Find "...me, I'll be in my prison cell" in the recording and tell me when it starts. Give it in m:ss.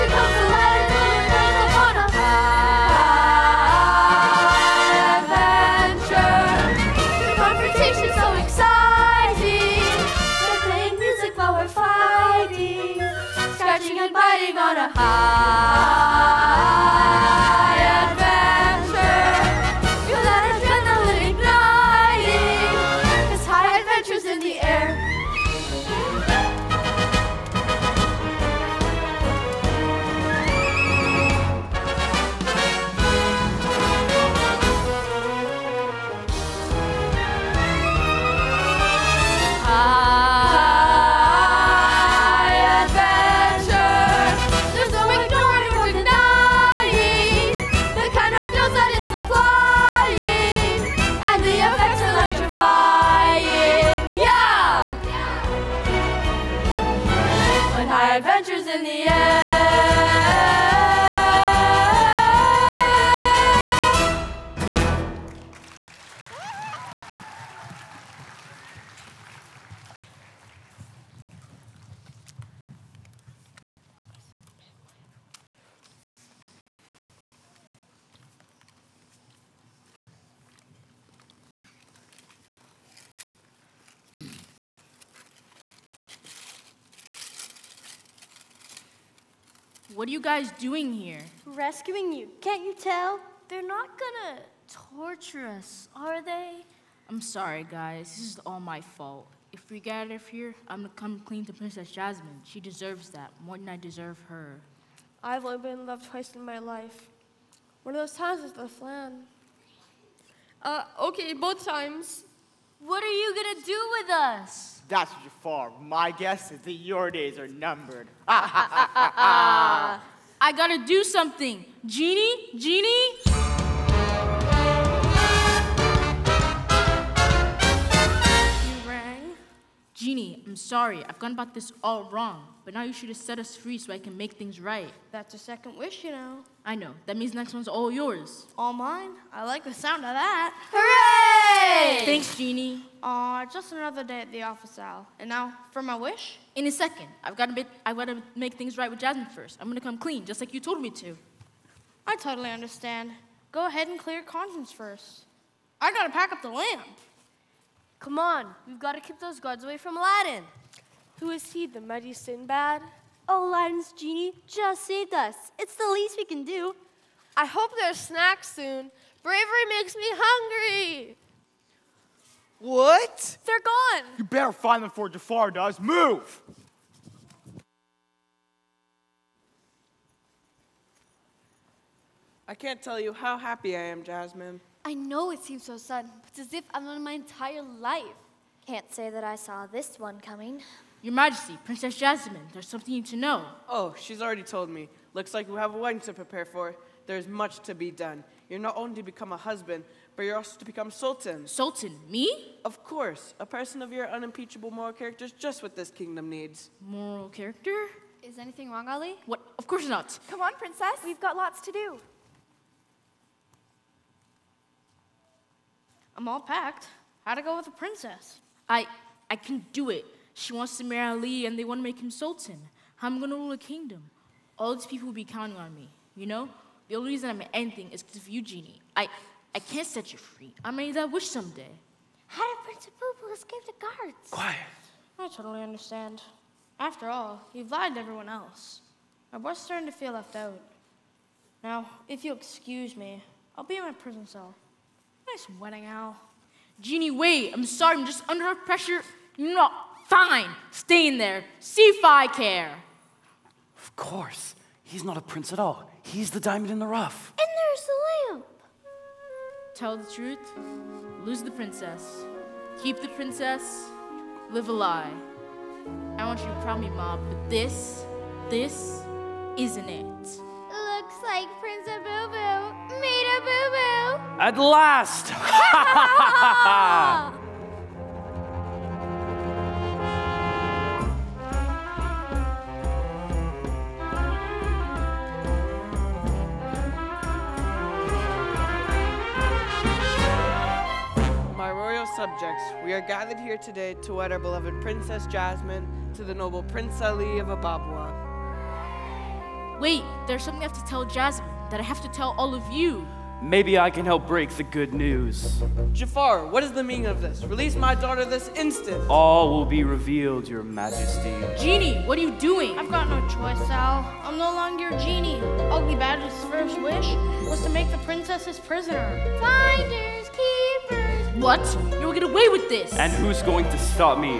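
4:02.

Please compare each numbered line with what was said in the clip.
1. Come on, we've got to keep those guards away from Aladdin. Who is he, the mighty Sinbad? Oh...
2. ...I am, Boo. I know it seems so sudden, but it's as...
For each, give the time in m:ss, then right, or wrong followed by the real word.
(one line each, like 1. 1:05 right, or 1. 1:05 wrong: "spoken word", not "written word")
1. 2:37 right
2. 3:03 wrong: "Jasmine", not "Boo".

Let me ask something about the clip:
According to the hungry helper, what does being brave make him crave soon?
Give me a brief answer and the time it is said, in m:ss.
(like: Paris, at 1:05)
snacks, at 2:47.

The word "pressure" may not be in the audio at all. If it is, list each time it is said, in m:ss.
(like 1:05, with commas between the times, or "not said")
4:08.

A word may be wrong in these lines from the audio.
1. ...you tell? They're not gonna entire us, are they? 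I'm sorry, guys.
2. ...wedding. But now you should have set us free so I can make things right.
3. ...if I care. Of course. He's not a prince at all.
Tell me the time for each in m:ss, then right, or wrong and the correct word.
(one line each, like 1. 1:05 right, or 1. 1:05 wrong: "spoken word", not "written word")
1. 1:32 wrong: "torture", not "entire"
2. 2:12 wrong: "wrong", not "wedding"
3. 4:11 right.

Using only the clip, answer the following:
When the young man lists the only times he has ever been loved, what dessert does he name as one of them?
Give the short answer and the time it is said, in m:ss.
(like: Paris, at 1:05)
flan, at 1:48.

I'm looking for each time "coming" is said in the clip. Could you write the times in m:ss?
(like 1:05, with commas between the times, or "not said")
3:10.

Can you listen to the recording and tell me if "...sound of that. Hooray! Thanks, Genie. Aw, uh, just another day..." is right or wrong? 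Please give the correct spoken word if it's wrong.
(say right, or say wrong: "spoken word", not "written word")
right.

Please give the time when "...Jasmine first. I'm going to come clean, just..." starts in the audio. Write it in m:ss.
2:28.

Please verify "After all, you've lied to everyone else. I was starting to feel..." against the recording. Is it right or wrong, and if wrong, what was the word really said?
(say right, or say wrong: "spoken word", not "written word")
right.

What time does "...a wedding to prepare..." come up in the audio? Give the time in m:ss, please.
3:15.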